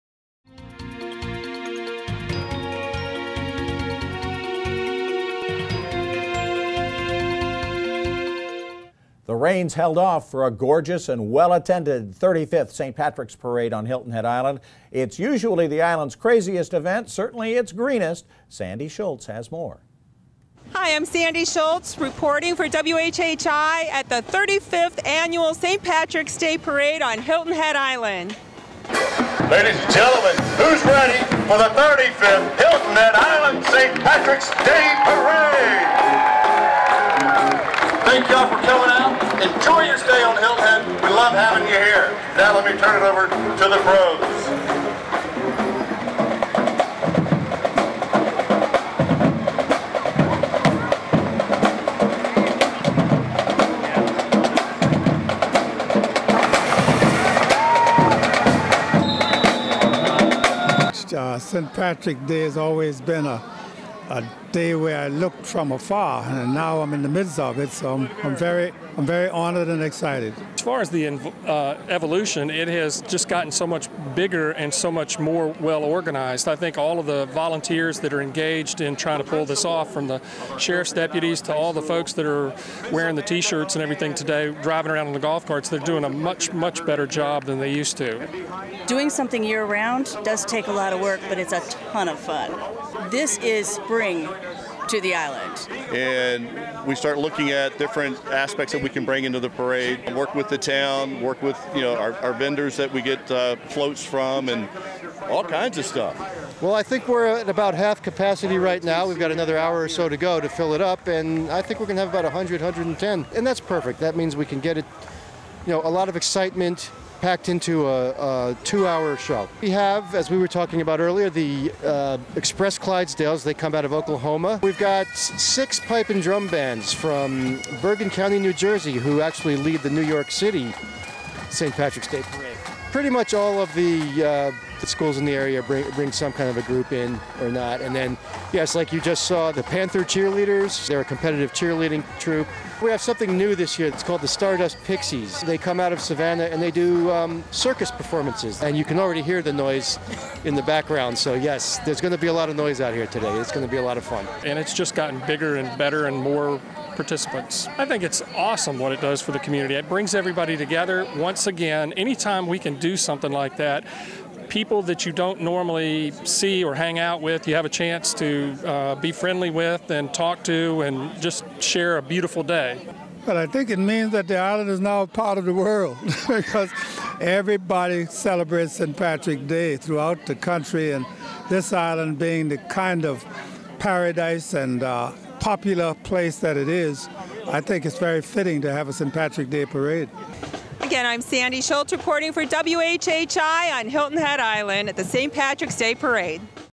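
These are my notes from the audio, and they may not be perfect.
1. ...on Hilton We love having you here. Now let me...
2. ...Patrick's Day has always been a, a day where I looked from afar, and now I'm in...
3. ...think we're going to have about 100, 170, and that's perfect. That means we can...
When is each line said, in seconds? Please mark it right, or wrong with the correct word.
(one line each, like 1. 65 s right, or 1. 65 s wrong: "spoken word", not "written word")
1. 40 s right
2. 61 s right
3. 111 s wrong: "110", not "170".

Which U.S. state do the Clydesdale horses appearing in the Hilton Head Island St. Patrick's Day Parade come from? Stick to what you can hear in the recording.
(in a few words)
Oklahoma.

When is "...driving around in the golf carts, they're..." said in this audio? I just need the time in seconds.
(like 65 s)
84 s.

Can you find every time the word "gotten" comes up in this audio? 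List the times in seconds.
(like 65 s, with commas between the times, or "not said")
73 s, 154 s.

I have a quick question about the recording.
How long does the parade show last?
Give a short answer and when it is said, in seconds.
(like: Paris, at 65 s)
2 hours, at 118 s.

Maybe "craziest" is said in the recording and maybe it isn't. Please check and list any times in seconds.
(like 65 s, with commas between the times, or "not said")
16 s.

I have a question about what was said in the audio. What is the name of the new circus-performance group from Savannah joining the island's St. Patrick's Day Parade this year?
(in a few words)
Stardust Pixies.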